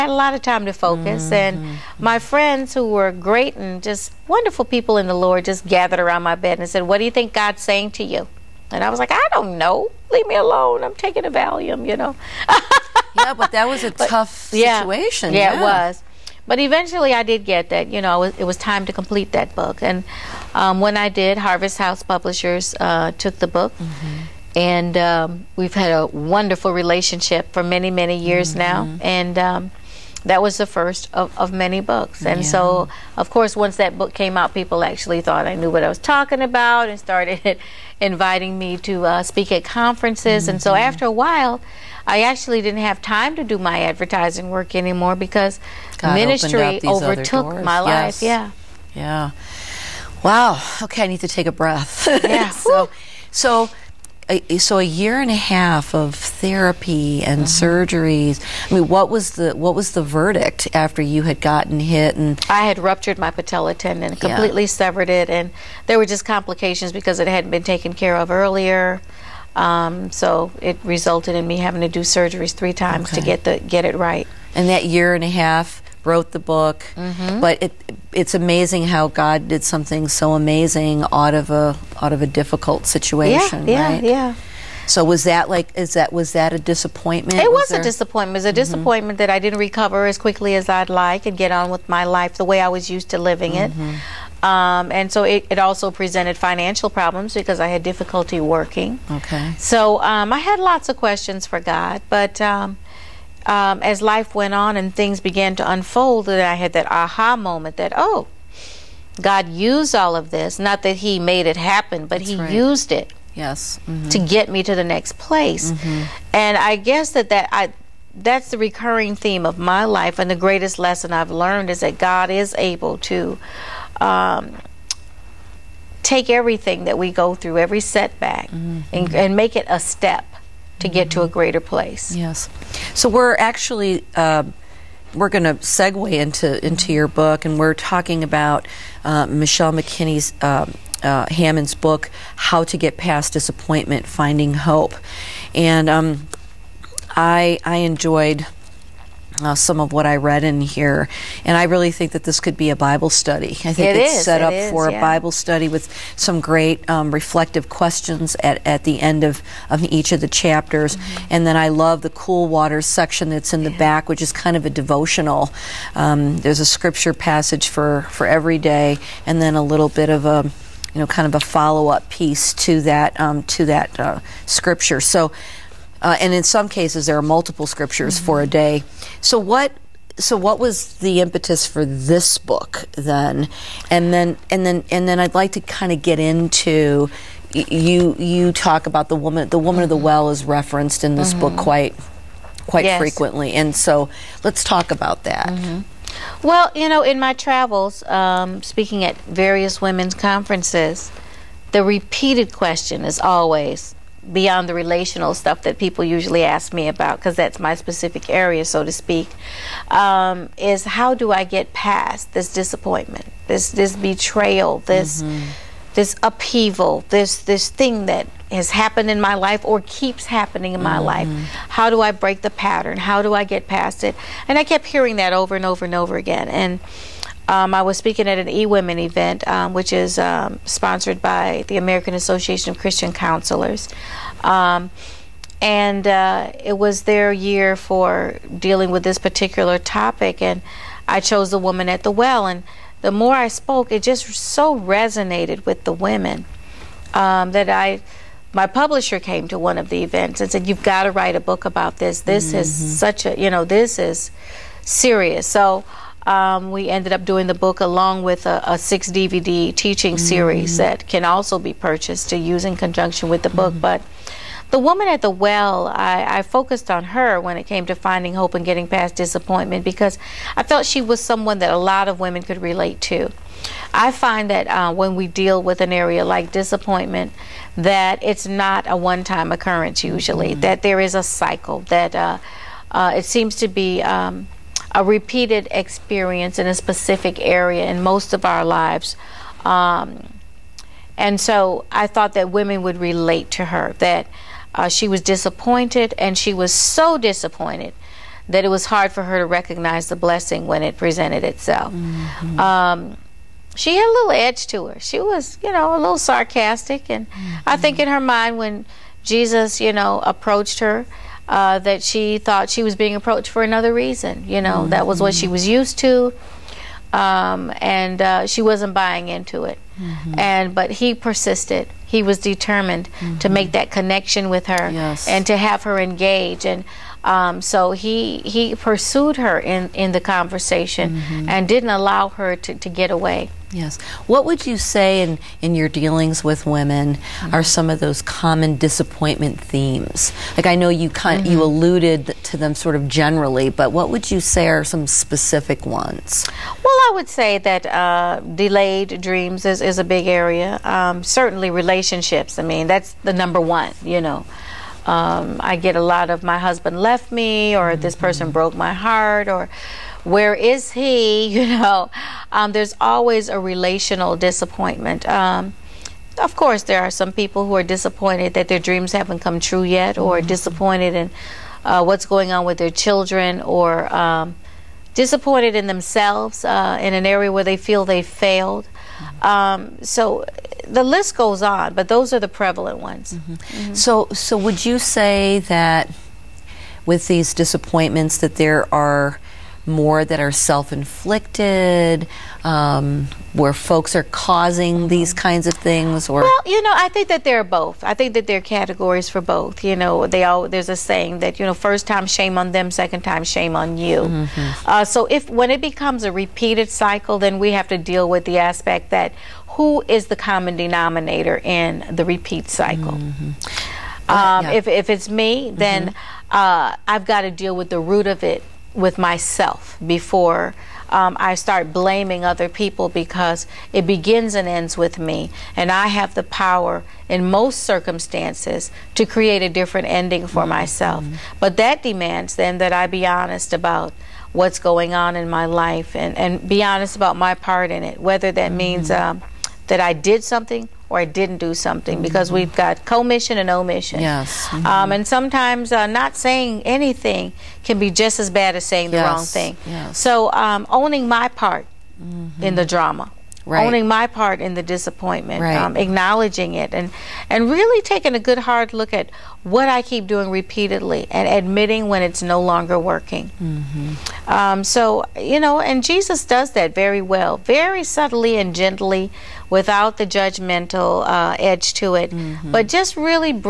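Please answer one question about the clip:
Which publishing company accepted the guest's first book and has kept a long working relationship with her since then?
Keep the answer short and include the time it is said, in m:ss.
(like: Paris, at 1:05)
Harvest House Publishers, at 0:21.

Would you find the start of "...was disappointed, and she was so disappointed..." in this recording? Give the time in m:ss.
4:55.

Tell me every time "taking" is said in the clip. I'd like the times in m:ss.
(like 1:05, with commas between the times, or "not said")
0:10, 7:38.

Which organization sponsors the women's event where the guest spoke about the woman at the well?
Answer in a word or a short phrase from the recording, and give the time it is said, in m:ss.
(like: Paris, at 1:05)
American Association of Christian Counselors, at 3:51.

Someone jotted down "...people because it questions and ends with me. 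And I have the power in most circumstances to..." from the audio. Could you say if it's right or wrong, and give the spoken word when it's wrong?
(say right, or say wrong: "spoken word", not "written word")
wrong: "begins", not "questions".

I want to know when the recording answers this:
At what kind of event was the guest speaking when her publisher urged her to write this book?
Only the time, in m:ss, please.
3:48.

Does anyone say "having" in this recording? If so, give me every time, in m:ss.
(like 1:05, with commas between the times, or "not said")
1:11.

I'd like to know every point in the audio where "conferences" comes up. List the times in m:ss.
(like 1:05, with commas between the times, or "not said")
0:39, 3:20.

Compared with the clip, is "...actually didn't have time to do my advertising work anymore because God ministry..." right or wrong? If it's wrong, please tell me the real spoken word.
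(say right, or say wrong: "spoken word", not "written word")
right.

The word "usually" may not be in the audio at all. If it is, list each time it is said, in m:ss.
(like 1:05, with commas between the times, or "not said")
3:26, 4:40.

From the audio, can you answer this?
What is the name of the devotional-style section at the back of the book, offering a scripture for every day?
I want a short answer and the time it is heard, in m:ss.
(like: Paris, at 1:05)
cool water section, at 2:42.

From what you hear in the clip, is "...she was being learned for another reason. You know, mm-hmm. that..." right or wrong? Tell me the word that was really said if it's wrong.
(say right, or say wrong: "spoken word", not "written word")
wrong: "approached", not "learned".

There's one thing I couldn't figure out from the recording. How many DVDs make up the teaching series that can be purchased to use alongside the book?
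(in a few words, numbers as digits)
6.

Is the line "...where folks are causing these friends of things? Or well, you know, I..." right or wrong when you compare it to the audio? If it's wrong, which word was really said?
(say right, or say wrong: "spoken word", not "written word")
wrong: "kinds", not "friends".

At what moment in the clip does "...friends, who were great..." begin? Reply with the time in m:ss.
0:02.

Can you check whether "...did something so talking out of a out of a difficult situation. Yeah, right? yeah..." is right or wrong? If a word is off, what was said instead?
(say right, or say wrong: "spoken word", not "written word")
wrong: "amazing", not "talking".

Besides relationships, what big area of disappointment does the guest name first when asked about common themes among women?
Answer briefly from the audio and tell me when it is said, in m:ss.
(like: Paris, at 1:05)
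delayed dreams, at 5:48.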